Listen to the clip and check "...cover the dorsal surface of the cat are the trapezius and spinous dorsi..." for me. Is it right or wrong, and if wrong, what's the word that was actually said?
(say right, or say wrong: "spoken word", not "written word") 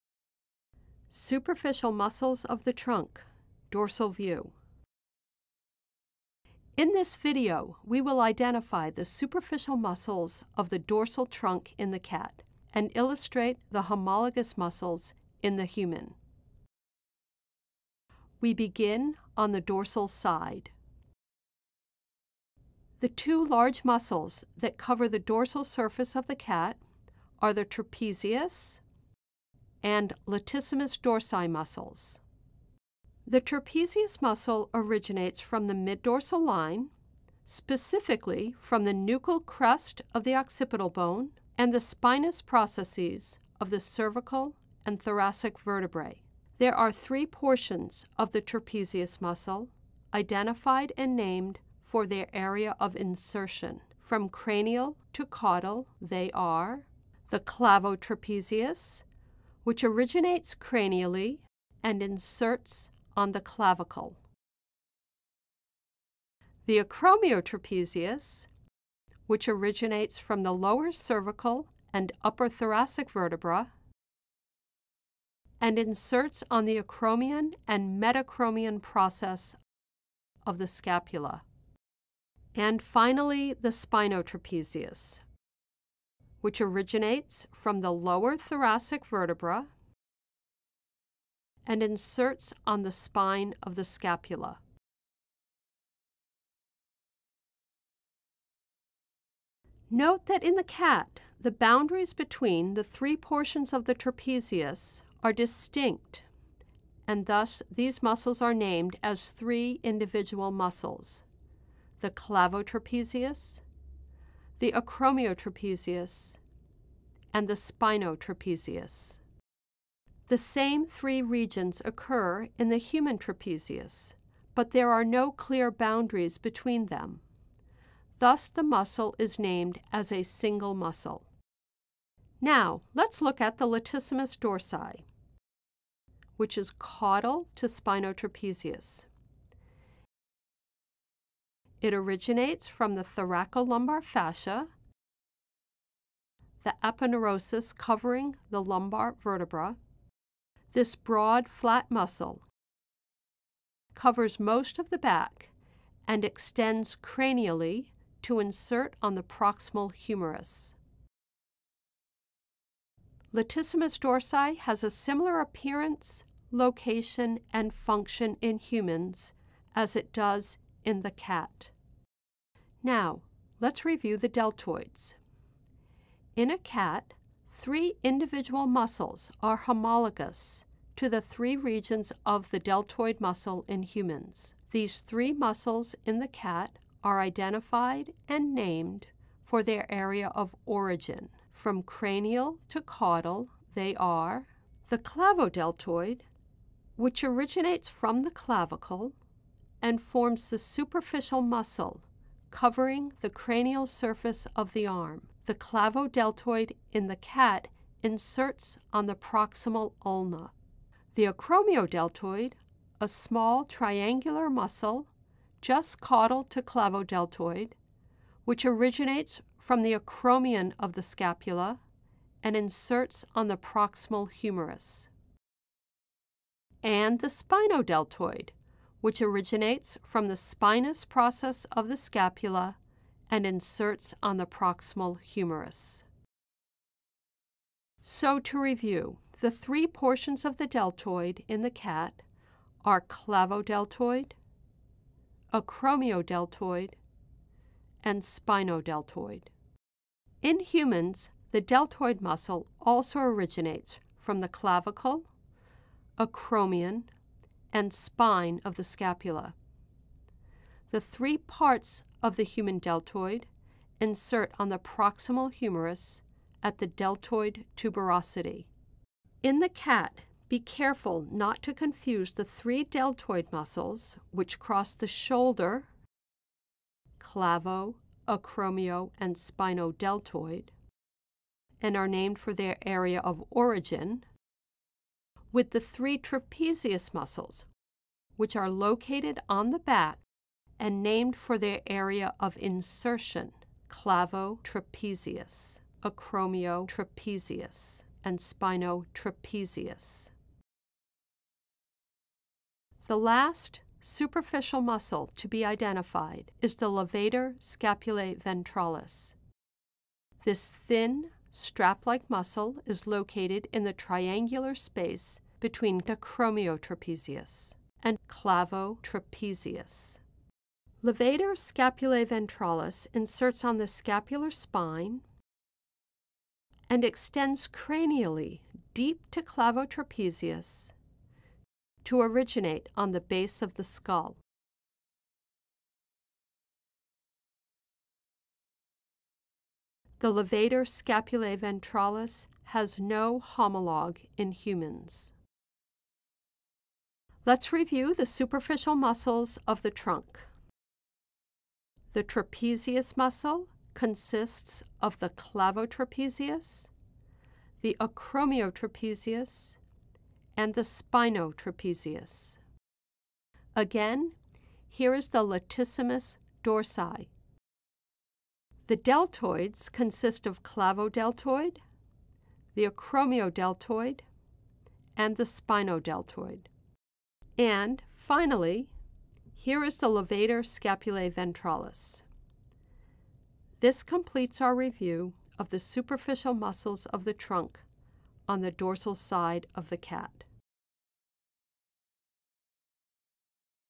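wrong: "latissimus", not "spinous".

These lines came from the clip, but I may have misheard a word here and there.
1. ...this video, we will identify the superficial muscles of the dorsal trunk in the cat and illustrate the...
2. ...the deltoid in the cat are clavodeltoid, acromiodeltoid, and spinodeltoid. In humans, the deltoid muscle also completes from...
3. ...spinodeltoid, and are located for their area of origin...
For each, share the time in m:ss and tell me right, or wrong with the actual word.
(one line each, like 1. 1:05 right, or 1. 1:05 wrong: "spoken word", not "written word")
1. 0:06 right
2. 4:00 wrong: "originates", not "completes"
3. 4:39 wrong: "named", not "located".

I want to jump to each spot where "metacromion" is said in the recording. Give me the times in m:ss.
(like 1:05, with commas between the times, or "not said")
1:18.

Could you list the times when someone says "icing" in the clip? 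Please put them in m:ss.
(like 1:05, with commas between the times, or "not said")
not said.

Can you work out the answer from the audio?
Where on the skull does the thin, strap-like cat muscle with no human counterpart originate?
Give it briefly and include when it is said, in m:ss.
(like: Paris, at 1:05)
base of the skull, at 5:33.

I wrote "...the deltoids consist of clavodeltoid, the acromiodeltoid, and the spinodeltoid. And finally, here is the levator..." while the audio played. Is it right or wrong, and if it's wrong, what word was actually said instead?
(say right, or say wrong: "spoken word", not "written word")
right.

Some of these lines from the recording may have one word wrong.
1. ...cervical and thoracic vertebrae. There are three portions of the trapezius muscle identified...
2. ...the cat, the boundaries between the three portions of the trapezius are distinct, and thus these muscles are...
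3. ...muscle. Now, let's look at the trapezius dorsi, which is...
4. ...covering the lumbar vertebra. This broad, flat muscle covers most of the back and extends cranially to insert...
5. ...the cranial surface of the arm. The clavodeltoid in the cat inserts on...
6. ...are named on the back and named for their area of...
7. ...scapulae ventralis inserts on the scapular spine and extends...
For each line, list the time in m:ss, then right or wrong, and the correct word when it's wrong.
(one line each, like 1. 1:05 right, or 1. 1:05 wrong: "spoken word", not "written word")
1. 0:43 right
2. 1:40 right
3. 2:10 wrong: "latissimus", not "trapezius"
4. 2:27 right
5. 3:23 right
6. 4:48 wrong: "located", not "named"
7. 5:21 right.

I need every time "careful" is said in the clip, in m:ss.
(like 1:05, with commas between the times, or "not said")
4:30.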